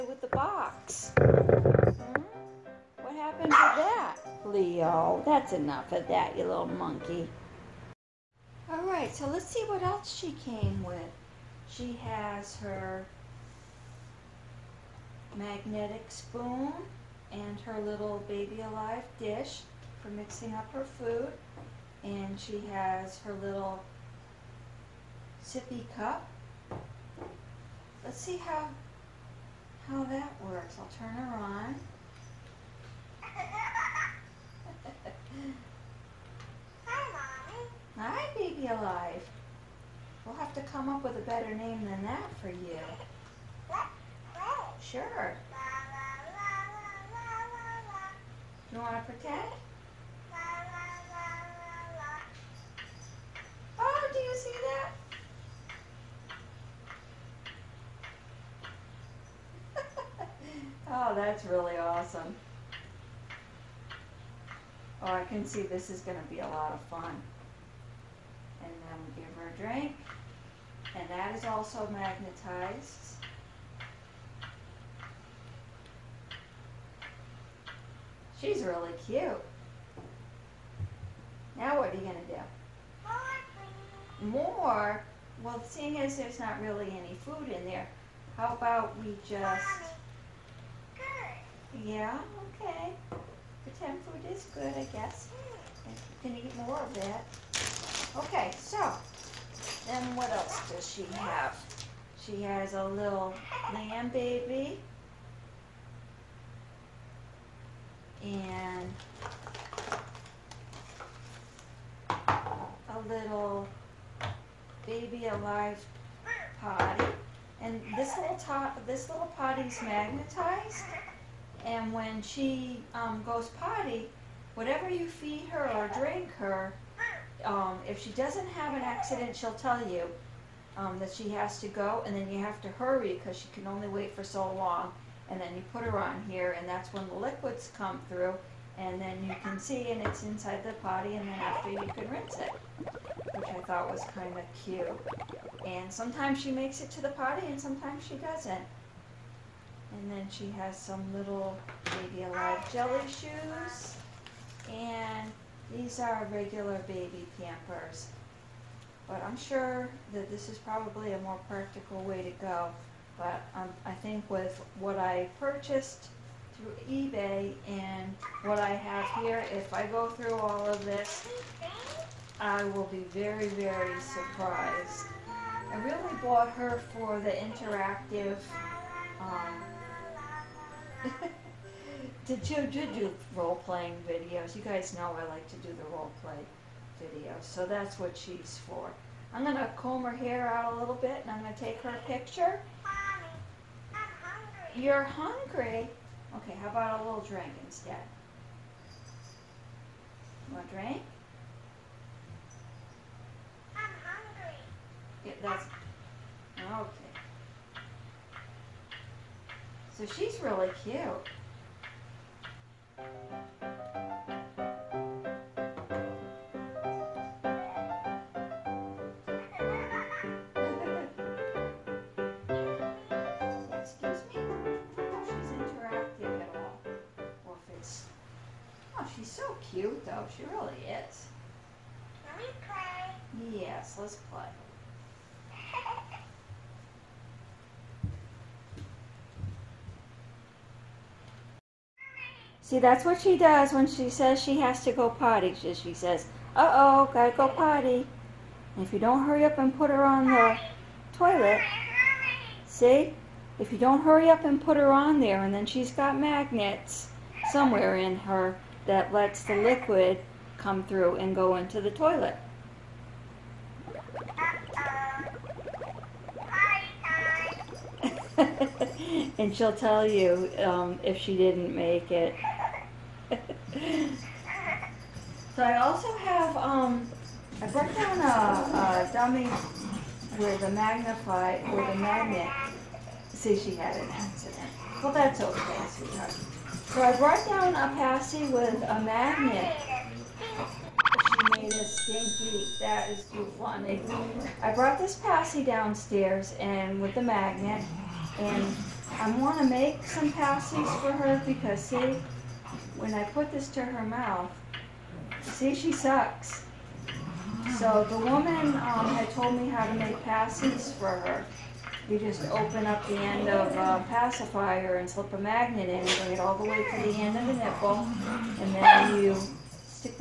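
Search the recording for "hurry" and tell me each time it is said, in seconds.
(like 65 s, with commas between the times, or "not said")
132 s, 249 s, 254 s.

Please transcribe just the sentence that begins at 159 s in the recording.
But I'm sure that this is probably a more practical way to go.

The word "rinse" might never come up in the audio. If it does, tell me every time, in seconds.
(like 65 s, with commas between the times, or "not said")
142 s.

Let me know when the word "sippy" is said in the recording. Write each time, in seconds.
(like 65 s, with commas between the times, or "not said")
25 s.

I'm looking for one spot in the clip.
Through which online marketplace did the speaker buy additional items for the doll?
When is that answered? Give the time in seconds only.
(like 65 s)
166 s.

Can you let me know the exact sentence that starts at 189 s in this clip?
I'm gonna comb her hair out a little bit, and I'm gonna take her picture.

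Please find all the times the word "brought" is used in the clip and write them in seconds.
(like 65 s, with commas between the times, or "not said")
277 s, 287 s, 294 s.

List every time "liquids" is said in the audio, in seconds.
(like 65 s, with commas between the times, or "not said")
137 s, 259 s.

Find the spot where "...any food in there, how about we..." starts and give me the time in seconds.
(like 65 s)
86 s.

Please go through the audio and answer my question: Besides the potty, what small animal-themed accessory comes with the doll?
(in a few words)
A little lamb baby.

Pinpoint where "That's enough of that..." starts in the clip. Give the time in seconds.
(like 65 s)
5 s.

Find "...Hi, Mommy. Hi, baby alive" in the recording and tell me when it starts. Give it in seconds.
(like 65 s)
36 s.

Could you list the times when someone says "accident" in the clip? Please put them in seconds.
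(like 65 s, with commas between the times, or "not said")
128 s, 284 s.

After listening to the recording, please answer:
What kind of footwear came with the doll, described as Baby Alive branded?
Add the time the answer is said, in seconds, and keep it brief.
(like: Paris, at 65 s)
Jelly shoes, at 152 s.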